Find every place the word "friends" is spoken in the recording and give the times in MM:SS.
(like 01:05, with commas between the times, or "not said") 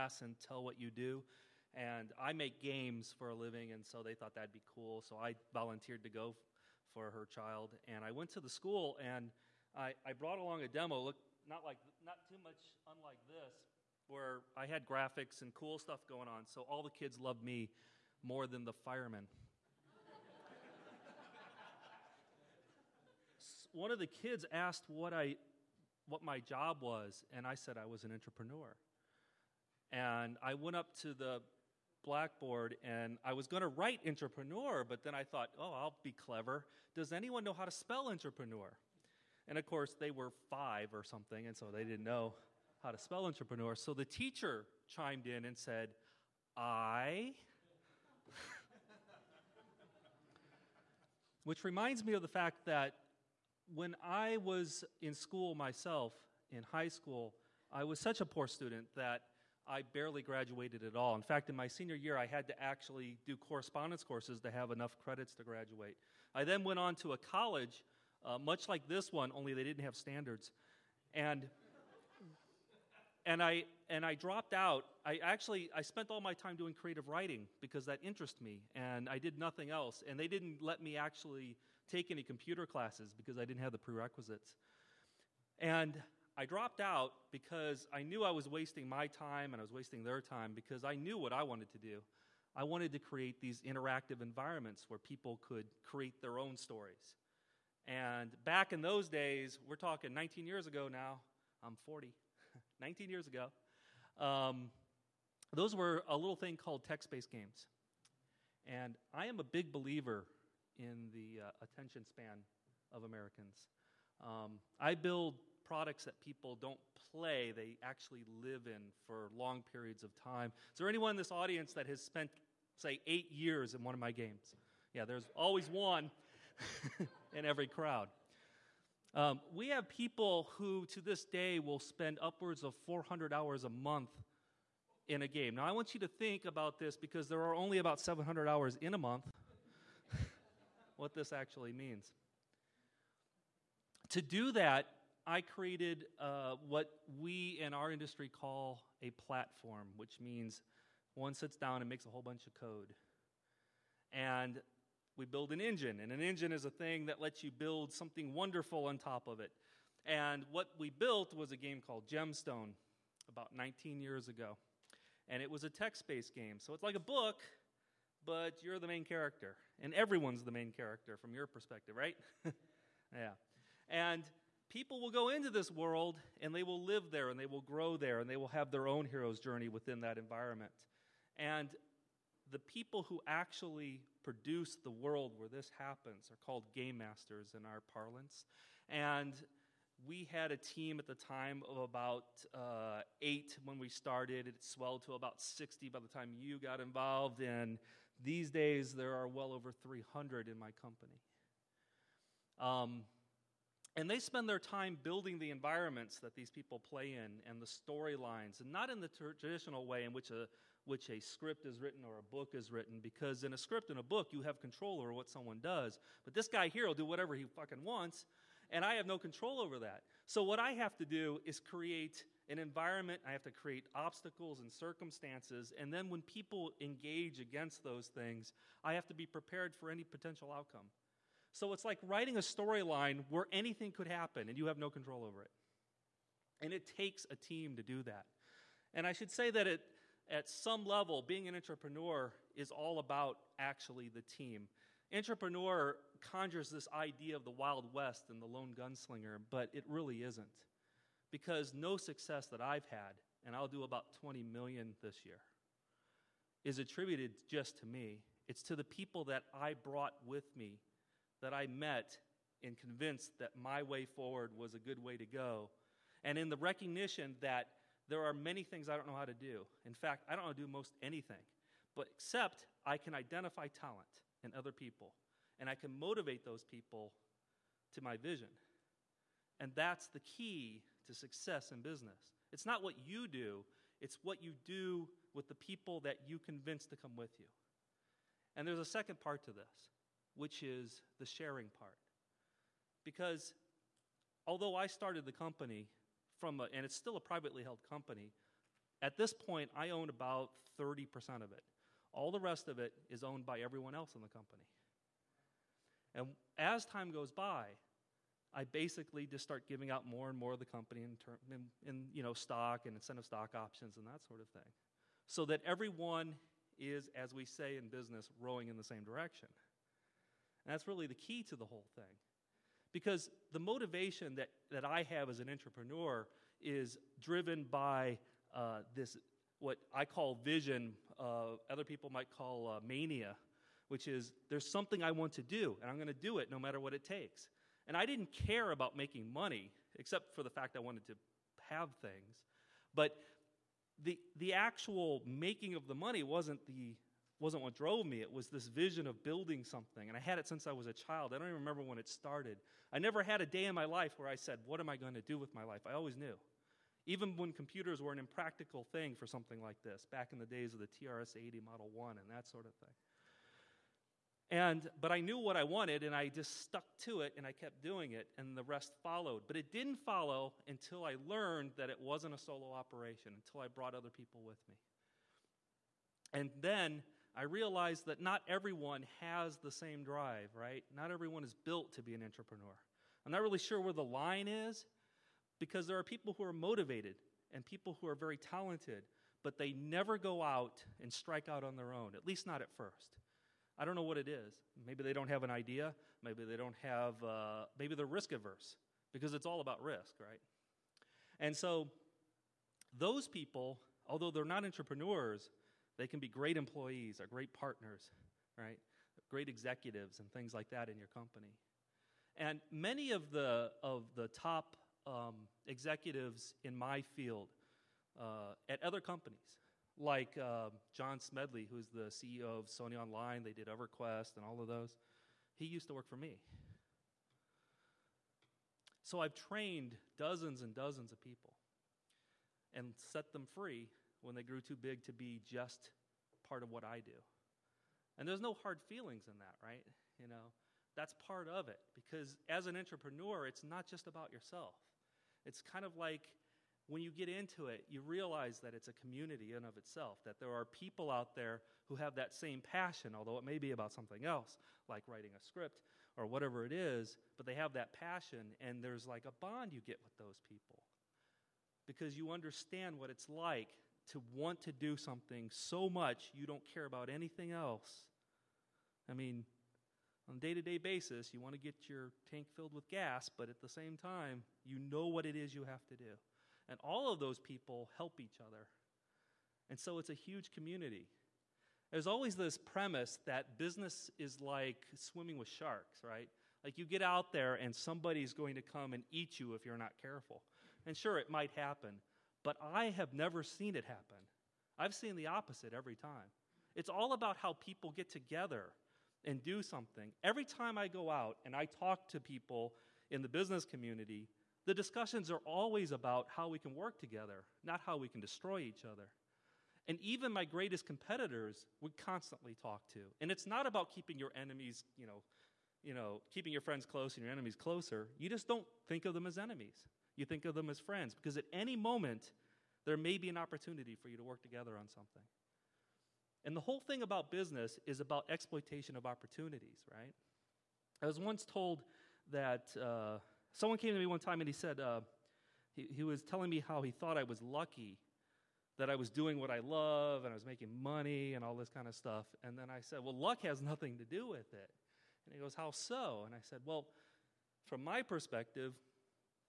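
08:36, 08:40.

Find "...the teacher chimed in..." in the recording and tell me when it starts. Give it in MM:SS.
00:43.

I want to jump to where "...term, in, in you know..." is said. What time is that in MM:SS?
05:11.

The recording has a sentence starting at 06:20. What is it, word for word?
Not everyone is built to be an entrepreneur.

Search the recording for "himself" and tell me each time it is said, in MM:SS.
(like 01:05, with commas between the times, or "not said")
not said.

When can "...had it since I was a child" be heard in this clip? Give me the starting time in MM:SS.
05:50.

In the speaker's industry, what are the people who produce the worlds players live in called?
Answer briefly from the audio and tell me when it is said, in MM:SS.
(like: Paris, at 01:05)
game masters, at 03:06.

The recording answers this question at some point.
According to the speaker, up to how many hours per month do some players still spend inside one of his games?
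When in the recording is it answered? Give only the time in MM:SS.
02:12.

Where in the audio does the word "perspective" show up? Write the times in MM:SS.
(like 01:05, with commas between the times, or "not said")
02:51, 09:08.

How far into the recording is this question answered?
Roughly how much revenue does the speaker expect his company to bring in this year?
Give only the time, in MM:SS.
04:14.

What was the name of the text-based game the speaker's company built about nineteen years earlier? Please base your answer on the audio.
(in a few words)
Gemstone.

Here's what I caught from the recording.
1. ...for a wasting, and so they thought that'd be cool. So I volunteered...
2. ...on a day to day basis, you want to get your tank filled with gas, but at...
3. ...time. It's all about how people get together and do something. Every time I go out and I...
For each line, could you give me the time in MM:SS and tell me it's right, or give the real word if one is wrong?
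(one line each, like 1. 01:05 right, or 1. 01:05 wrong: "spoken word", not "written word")
1. 00:03 wrong: "living", not "wasting"
2. 07:50 right
3. 08:15 right.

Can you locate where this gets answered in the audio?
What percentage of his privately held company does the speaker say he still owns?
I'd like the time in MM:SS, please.
05:00.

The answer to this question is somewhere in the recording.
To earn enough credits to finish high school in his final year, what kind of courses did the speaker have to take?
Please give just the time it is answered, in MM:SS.
01:03.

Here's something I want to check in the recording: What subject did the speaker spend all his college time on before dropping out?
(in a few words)
creative writing.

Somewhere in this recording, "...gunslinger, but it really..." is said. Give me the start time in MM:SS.
04:08.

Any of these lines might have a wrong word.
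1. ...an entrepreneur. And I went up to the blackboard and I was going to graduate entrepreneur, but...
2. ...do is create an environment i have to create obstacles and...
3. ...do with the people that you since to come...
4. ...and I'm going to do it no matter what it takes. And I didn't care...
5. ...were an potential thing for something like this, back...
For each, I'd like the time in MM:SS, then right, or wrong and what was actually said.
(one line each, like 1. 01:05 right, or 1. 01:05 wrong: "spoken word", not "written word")
1. 00:28 wrong: "write", not "graduate"
2. 03:41 right
3. 04:44 wrong: "convince", not "since"
4. 05:35 right
5. 05:58 wrong: "impractical", not "potential".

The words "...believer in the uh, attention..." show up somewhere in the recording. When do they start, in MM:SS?
01:49.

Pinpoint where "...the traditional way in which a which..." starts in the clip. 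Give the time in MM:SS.
03:29.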